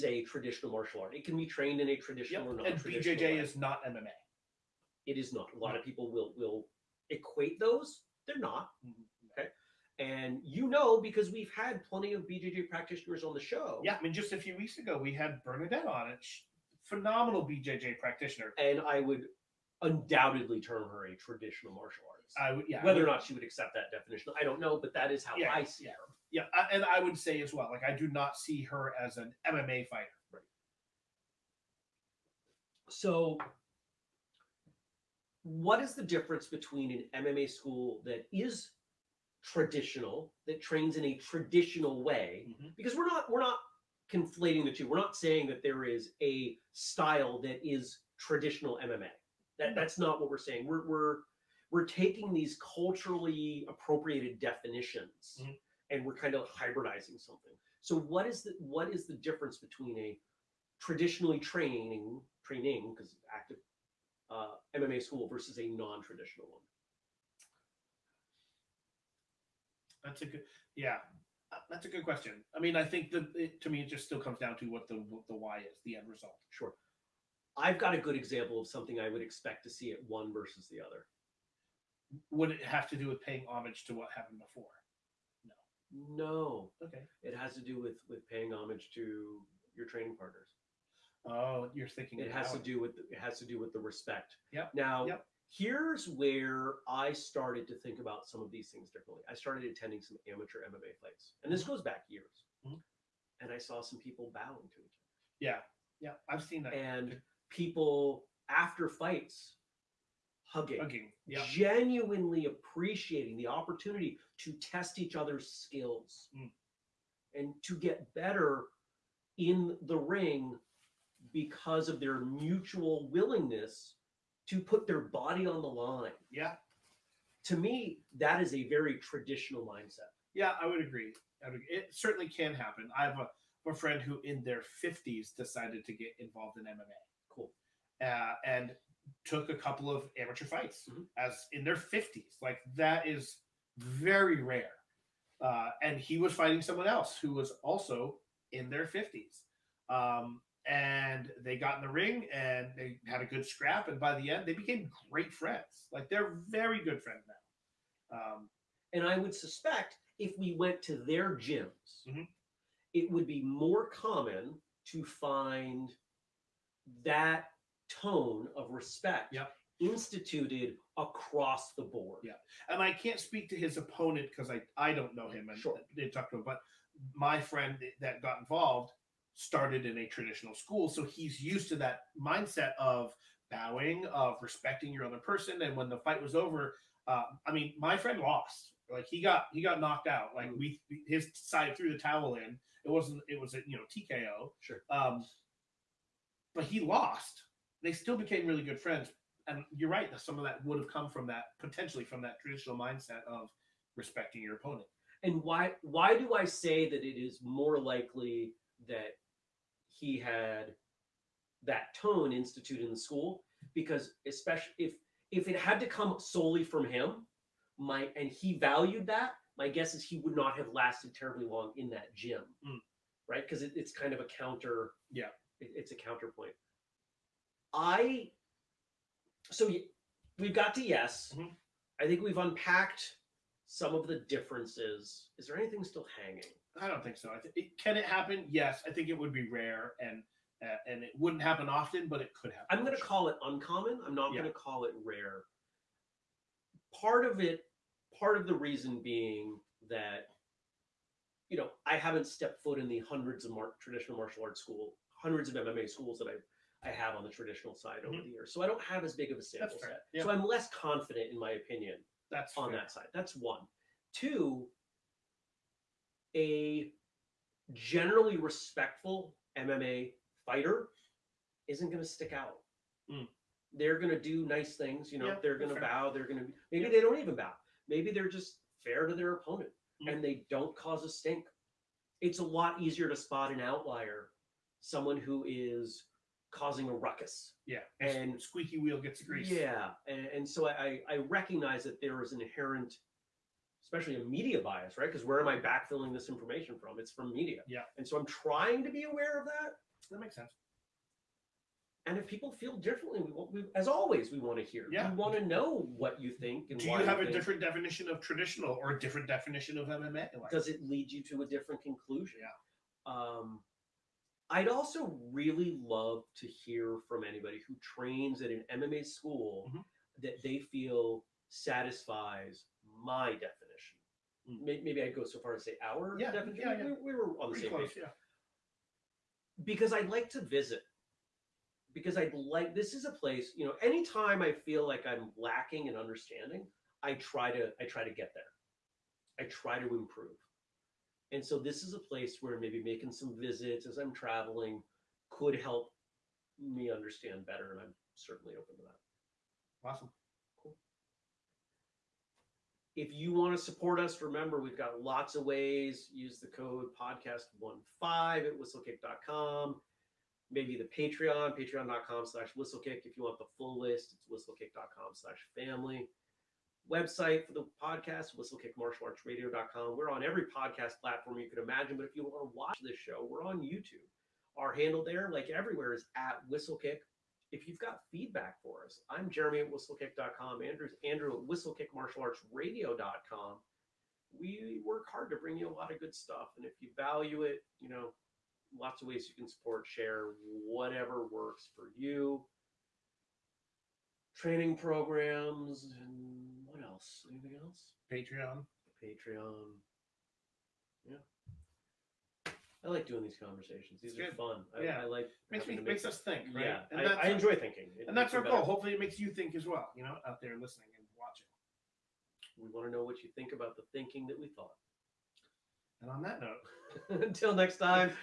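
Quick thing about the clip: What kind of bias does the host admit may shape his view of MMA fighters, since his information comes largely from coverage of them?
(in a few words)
media bias.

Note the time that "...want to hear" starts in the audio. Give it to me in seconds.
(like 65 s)
304 s.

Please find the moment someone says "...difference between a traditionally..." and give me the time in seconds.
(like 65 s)
59 s.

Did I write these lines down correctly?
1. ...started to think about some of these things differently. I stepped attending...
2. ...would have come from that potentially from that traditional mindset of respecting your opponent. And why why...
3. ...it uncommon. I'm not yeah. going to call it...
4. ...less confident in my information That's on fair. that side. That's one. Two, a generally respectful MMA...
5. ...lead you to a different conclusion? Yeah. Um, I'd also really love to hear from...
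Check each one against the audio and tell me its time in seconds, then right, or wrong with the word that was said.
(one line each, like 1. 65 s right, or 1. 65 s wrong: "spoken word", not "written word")
1. 97 s wrong: "started", not "stepped"
2. 200 s right
3. 243 s right
4. 260 s wrong: "opinion", not "information"
5. 310 s right.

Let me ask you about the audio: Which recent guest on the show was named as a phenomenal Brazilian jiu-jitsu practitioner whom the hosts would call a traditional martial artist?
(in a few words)
Bernadette.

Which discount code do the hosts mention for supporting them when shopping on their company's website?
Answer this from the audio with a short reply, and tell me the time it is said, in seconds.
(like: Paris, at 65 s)
podcast15, at 357 s.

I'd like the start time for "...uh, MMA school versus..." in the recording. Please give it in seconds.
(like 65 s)
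64 s.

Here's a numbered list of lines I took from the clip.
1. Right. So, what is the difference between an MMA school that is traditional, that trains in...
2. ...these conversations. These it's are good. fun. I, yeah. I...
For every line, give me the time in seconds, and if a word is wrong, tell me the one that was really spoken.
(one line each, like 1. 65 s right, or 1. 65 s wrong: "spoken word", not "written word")
1. 30 s right
2. 403 s right.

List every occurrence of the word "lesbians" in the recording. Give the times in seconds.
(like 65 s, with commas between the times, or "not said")
not said.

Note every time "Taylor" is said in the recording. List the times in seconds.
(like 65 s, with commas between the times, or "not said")
not said.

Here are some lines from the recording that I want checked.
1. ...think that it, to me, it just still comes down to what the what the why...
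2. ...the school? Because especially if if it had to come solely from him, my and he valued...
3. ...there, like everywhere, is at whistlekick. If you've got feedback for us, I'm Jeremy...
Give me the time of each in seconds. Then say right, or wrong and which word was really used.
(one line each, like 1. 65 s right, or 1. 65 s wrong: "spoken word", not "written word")
1. 72 s right
2. 212 s right
3. 375 s right.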